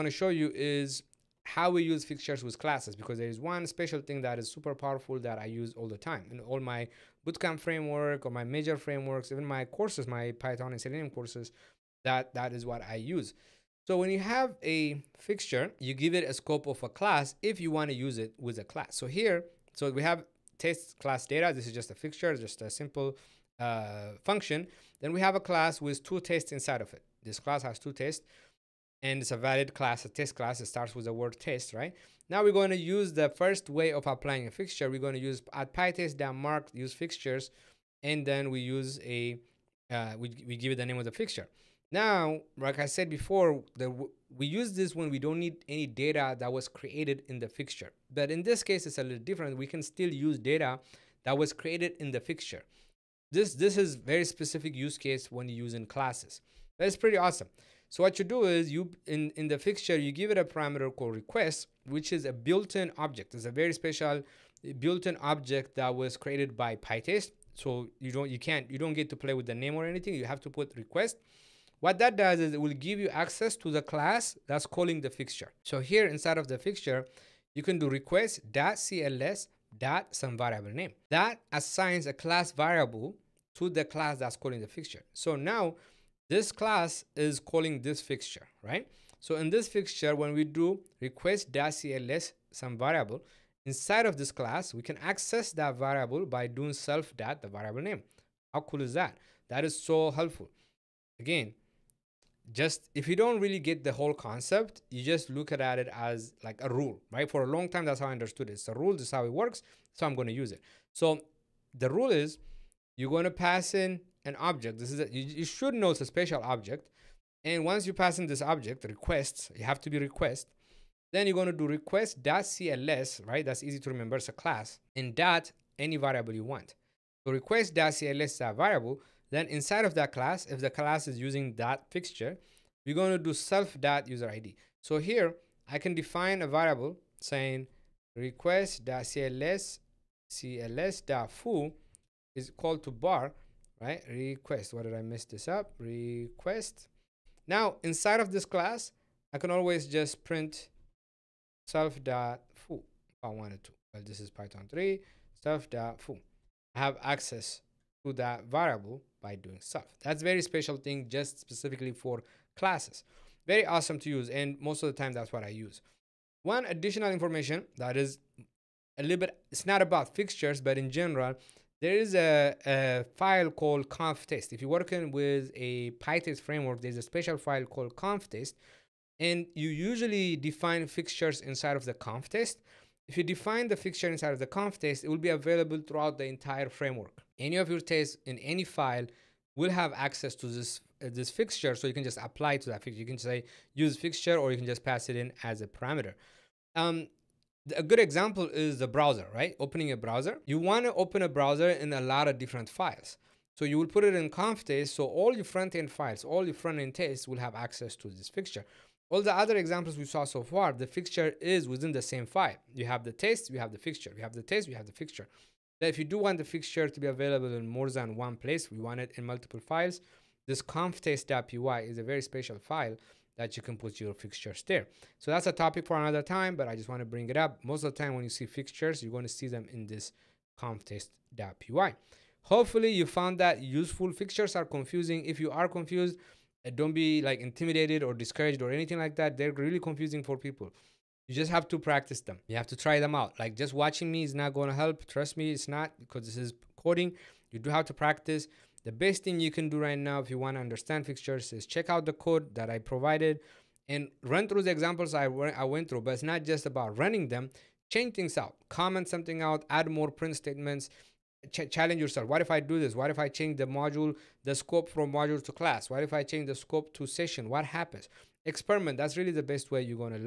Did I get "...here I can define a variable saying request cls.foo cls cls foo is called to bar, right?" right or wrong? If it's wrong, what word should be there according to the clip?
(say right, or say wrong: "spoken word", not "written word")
right.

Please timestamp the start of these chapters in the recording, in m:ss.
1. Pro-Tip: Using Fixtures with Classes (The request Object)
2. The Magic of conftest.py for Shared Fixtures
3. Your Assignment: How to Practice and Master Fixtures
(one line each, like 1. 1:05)
1. 0:43
2. 2:43
3. 4:13.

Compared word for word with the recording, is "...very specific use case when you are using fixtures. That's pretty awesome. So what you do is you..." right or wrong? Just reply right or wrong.
wrong.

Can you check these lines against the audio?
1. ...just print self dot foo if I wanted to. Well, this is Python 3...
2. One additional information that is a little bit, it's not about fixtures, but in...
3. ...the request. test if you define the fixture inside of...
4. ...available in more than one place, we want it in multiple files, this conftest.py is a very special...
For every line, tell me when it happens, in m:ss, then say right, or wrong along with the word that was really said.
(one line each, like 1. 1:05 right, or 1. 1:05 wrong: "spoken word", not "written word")
1. 2:29 right
2. 2:46 right
3. 3:01 wrong: "conftest", not "request"
4. 3:37 right.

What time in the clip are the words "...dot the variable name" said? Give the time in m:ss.
1:37.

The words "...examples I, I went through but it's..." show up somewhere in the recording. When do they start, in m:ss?
4:14.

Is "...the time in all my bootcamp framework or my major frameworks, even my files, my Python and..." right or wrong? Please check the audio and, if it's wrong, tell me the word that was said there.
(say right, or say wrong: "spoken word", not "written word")
wrong: "courses", not "files".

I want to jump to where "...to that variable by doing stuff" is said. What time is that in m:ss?
2:38.